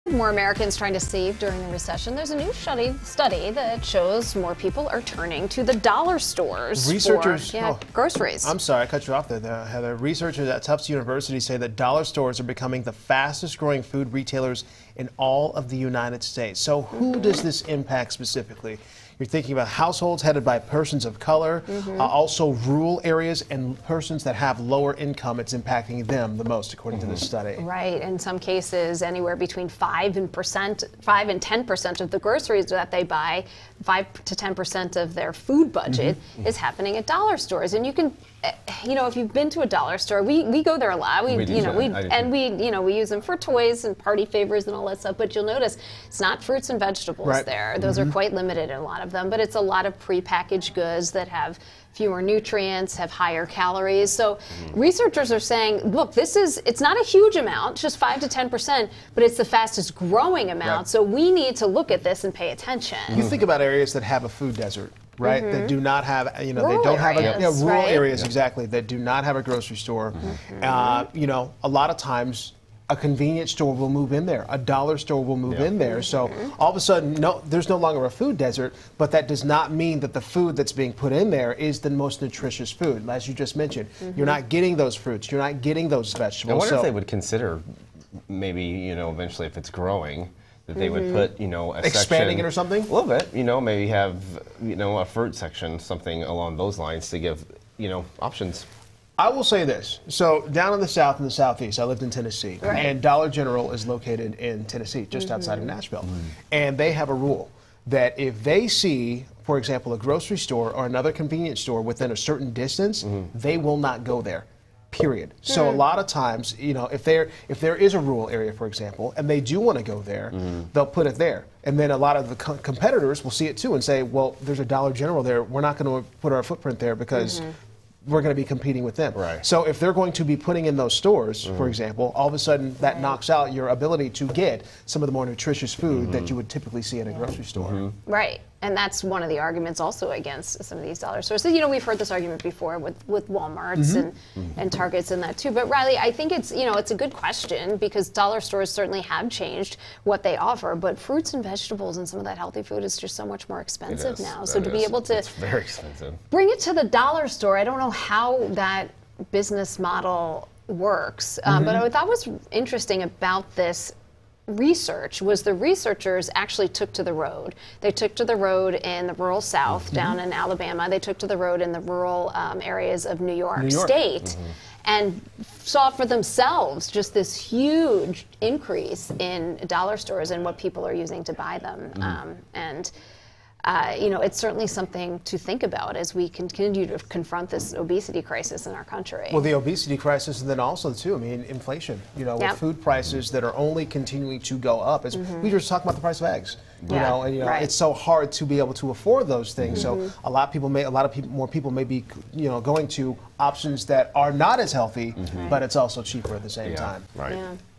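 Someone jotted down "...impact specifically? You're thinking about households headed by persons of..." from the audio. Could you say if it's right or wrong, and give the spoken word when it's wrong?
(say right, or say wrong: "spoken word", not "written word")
right.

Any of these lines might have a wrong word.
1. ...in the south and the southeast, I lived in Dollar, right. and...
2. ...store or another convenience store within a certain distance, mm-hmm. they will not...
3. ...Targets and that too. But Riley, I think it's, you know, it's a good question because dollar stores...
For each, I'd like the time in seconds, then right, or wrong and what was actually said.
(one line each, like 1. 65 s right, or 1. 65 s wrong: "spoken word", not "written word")
1. 100 s wrong: "Tennessee", not "Dollar"
2. 110 s right
3. 144 s right.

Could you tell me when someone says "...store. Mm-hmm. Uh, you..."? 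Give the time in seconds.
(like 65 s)
69 s.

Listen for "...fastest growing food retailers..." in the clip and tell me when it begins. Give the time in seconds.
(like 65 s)
12 s.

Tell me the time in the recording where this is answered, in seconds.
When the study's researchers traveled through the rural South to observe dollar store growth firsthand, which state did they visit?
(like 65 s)
170 s.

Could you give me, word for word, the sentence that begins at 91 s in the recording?
put, you know, a expanding section, it or something.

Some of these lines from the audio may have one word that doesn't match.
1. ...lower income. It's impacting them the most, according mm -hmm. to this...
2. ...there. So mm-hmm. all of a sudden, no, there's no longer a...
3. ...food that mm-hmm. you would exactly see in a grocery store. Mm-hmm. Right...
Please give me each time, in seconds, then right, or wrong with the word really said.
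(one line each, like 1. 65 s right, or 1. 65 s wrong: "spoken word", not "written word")
1. 24 s right
2. 75 s right
3. 135 s wrong: "typically", not "exactly".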